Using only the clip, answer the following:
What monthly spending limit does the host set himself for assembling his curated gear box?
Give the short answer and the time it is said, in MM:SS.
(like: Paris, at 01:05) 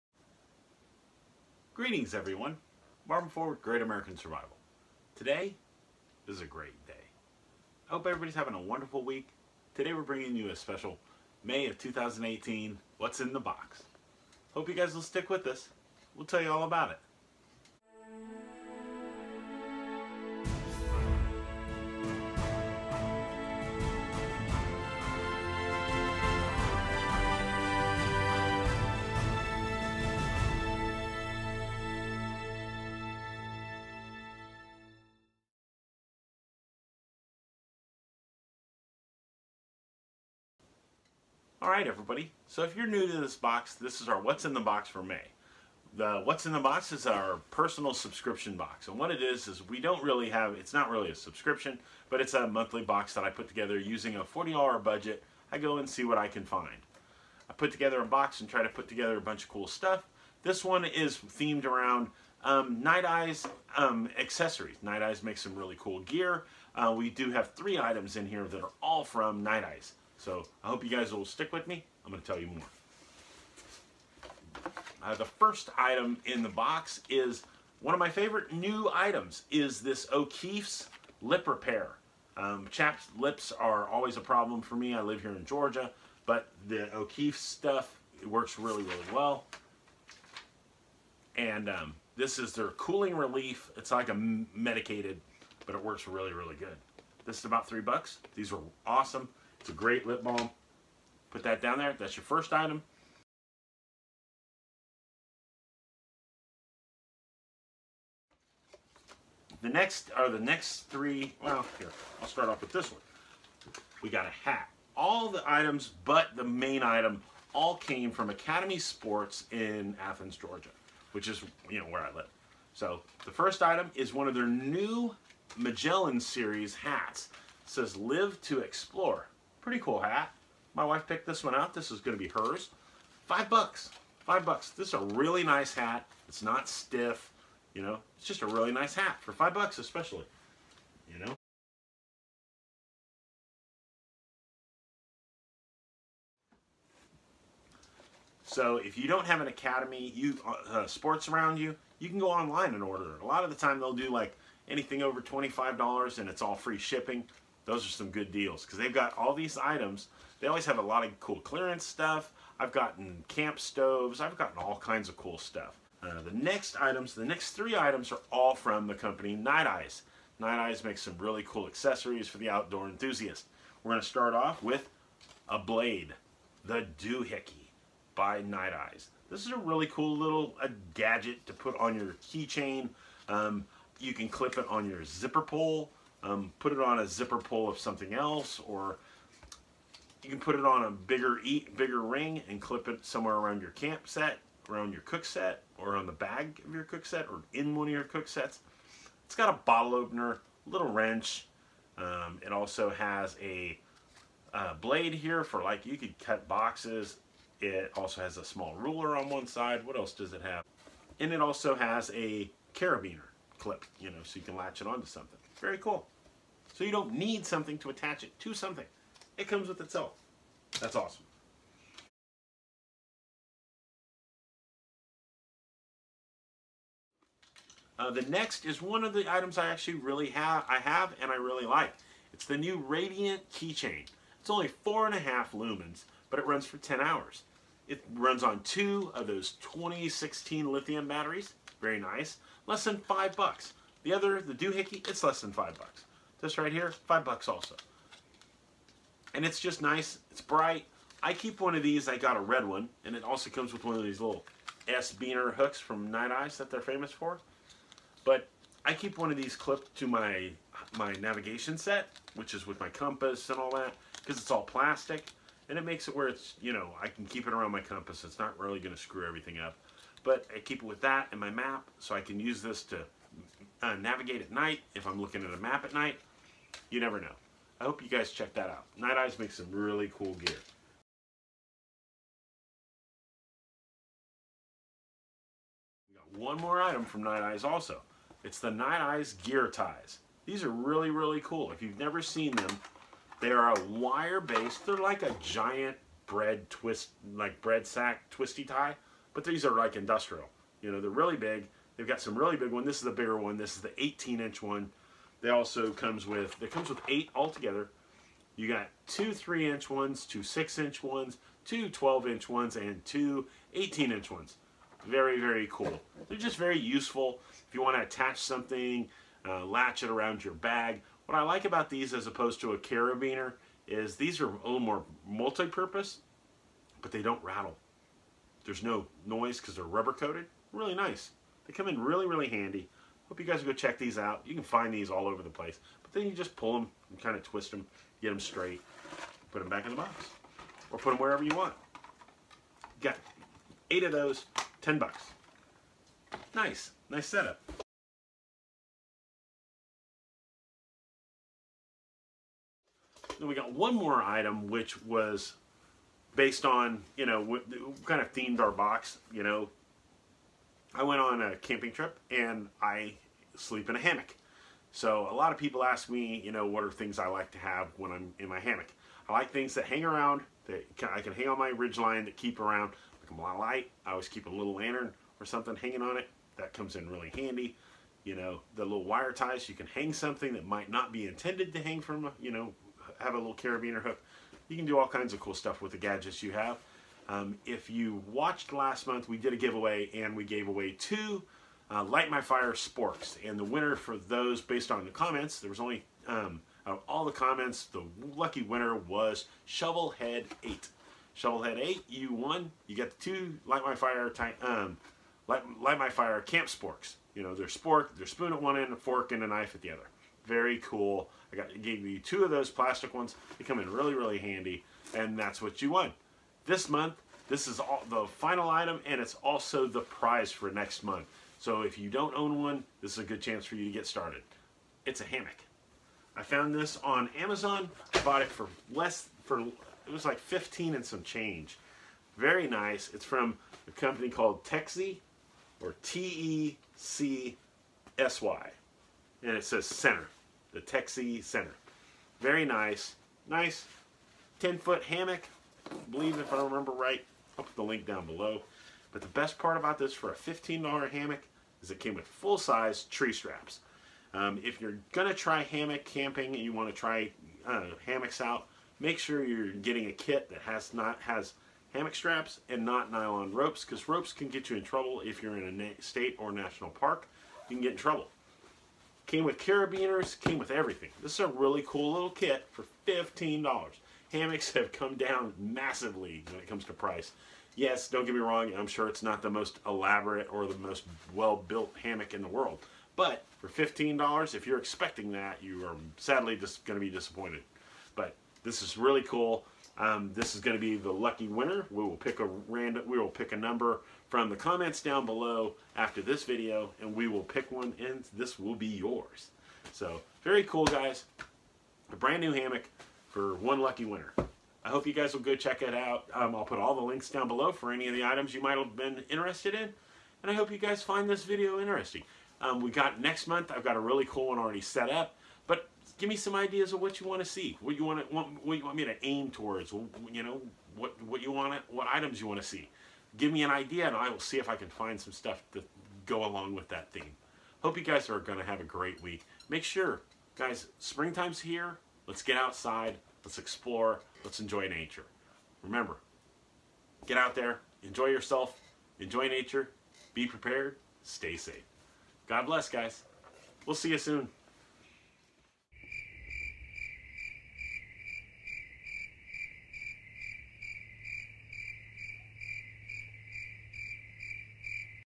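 $40, at 00:54.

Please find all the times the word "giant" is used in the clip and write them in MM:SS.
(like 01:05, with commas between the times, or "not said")
04:55.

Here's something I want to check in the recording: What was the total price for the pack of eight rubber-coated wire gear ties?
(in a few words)
$10.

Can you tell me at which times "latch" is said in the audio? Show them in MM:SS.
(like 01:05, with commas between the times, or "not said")
03:34, 05:19.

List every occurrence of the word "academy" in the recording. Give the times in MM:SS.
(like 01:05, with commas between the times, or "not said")
01:58, 02:29.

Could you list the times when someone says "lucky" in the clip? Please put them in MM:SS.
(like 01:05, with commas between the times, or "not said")
06:38, 08:11, 08:23.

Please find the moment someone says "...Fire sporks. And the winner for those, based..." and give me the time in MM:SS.
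06:32.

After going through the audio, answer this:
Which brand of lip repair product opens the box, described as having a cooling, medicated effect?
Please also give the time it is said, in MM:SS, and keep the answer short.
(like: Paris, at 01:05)
O'Keeffe's, at 01:20.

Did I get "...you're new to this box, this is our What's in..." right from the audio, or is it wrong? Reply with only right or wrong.
right.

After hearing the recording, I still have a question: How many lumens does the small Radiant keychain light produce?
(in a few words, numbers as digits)
4.5.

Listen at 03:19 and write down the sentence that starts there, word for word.
It's got a bottle opener, little wrench.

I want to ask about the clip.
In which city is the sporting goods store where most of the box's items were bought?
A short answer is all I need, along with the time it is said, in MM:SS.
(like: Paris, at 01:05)
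Athens, Georgia, at 02:00.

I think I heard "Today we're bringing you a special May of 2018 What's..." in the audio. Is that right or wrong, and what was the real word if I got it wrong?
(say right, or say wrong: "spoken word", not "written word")
right.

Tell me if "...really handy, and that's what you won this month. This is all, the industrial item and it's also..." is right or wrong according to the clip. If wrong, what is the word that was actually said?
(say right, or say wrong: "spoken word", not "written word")
wrong: "final", not "industrial".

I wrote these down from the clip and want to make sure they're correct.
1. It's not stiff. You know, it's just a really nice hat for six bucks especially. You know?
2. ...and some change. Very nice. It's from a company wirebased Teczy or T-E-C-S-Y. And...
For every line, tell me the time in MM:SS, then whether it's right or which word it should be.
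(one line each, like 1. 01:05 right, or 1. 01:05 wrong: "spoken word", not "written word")
1. 02:16 wrong: "five", not "six"
2. 07:10 wrong: "called", not "wirebased".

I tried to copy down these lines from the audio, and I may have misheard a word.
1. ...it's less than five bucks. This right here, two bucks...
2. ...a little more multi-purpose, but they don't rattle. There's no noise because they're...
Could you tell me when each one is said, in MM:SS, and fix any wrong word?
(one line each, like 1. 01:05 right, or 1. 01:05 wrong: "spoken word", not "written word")
1. 04:05 wrong: "five", not "two"
2. 05:24 right.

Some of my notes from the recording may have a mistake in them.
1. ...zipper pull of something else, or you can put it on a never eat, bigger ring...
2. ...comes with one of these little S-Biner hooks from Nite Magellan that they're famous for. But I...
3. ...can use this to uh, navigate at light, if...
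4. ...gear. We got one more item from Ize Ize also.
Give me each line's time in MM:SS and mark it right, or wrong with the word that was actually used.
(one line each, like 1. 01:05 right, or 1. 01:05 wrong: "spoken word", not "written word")
1. 03:07 wrong: "bigger", not "never"
2. 04:13 wrong: "Ize", not "Magellan"
3. 04:32 wrong: "night", not "light"
4. 04:40 wrong: "Nite", not "Ize".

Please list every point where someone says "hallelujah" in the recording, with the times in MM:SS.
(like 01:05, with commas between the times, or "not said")
not said.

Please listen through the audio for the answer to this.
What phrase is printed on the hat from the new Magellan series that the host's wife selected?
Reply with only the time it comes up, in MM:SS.
02:07.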